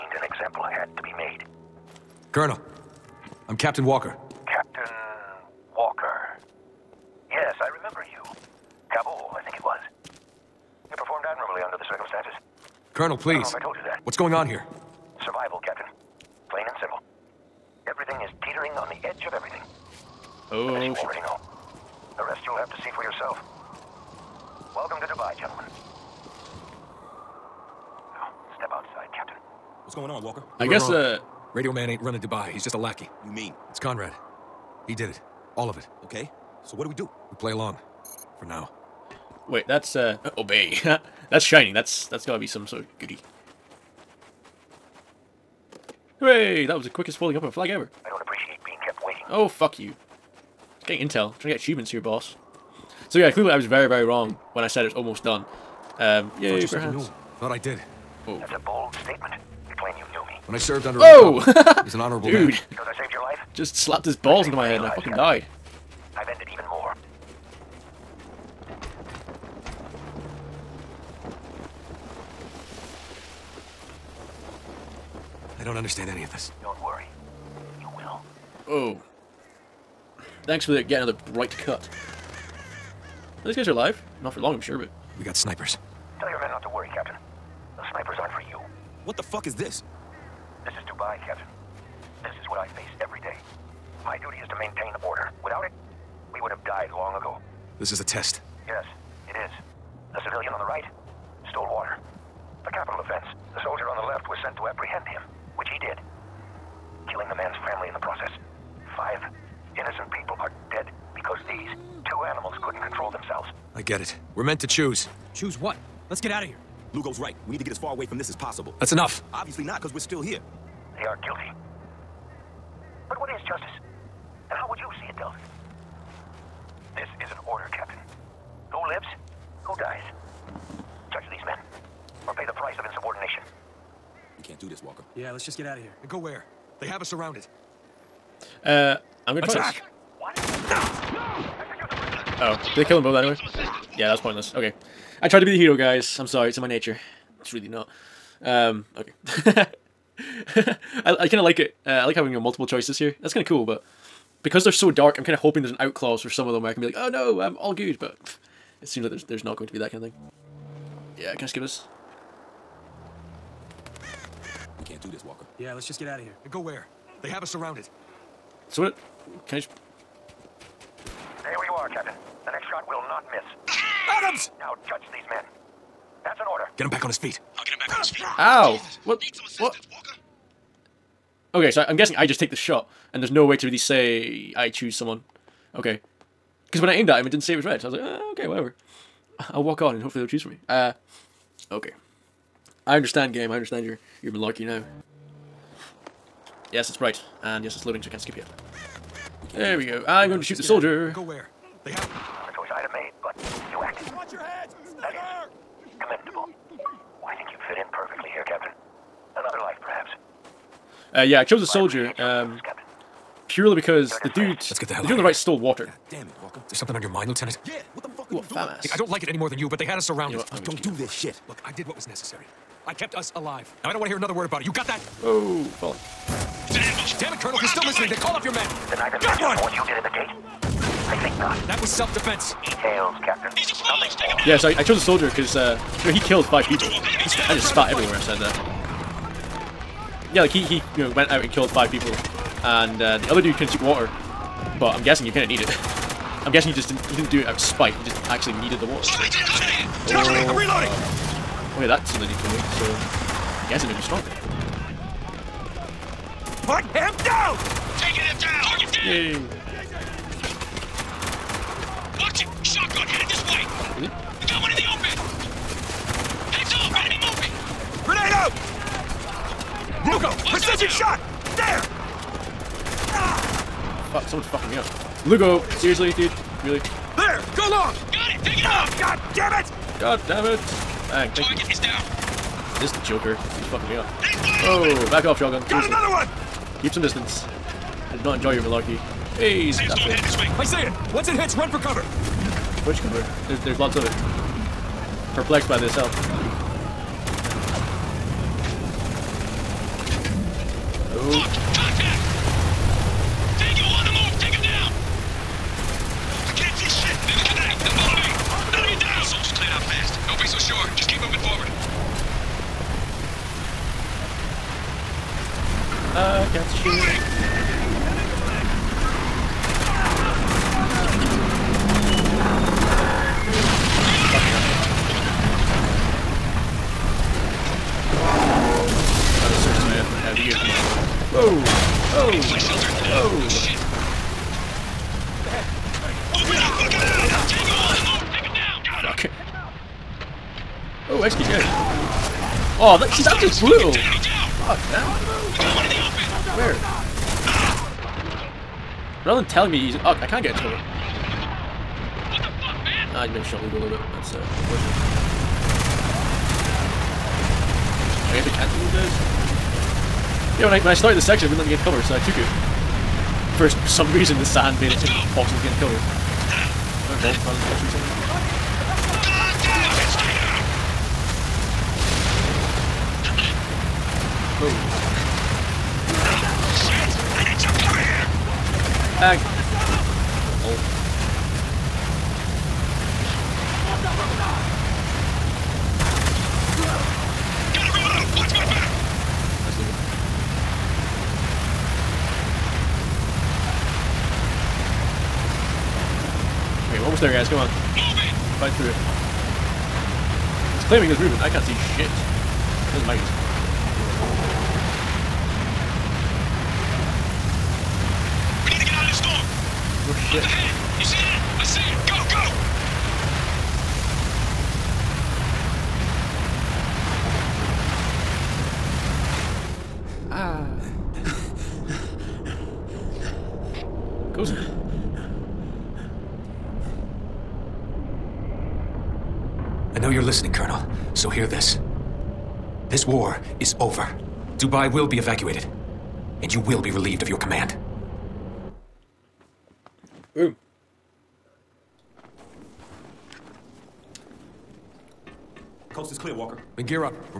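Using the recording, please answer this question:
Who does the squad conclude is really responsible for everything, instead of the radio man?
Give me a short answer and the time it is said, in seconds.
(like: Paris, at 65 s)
Conrad, at 33 s.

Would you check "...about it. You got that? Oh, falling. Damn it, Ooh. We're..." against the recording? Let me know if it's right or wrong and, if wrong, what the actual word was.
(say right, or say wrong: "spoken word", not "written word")
wrong: "Colonel", not "Ooh".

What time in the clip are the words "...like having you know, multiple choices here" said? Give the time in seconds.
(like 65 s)
152 s.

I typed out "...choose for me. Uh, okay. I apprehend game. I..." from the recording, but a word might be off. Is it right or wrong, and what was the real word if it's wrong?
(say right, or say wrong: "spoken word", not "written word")
wrong: "understand", not "apprehend".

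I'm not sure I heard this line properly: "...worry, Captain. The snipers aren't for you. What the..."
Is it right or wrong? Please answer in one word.
right.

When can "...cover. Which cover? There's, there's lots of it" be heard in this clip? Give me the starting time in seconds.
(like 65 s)
291 s.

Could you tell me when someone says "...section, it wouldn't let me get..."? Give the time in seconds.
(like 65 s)
361 s.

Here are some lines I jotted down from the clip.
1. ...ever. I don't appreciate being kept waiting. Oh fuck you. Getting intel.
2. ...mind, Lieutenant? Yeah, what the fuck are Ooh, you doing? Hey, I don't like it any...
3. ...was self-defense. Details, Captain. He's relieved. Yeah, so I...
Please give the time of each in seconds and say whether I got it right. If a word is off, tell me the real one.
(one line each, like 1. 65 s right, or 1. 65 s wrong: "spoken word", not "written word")
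1. 47 s right
2. 217 s right
3. 231 s wrong: "exposed", not "relieved".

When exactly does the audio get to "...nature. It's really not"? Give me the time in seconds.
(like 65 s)
146 s.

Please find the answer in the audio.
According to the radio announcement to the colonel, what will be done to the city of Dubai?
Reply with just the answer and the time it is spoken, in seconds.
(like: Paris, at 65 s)
Evacuated, at 435 s.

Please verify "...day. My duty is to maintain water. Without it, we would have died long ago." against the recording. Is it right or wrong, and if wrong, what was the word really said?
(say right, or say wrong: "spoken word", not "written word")
wrong: "order", not "water".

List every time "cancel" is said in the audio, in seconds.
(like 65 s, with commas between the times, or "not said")
358 s.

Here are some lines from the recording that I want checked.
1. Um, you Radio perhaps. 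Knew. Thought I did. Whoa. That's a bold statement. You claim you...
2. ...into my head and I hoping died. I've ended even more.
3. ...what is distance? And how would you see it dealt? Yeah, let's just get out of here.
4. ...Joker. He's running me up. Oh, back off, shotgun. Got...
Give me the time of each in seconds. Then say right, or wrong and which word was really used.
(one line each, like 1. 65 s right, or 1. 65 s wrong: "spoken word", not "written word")
1. 55 s wrong: "Thought", not "Radio"
2. 64 s wrong: "fucking", not "hoping"
3. 123 s wrong: "justice", not "distance"
4. 283 s wrong: "fucking", not "running".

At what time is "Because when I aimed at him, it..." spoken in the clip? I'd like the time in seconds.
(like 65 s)
186 s.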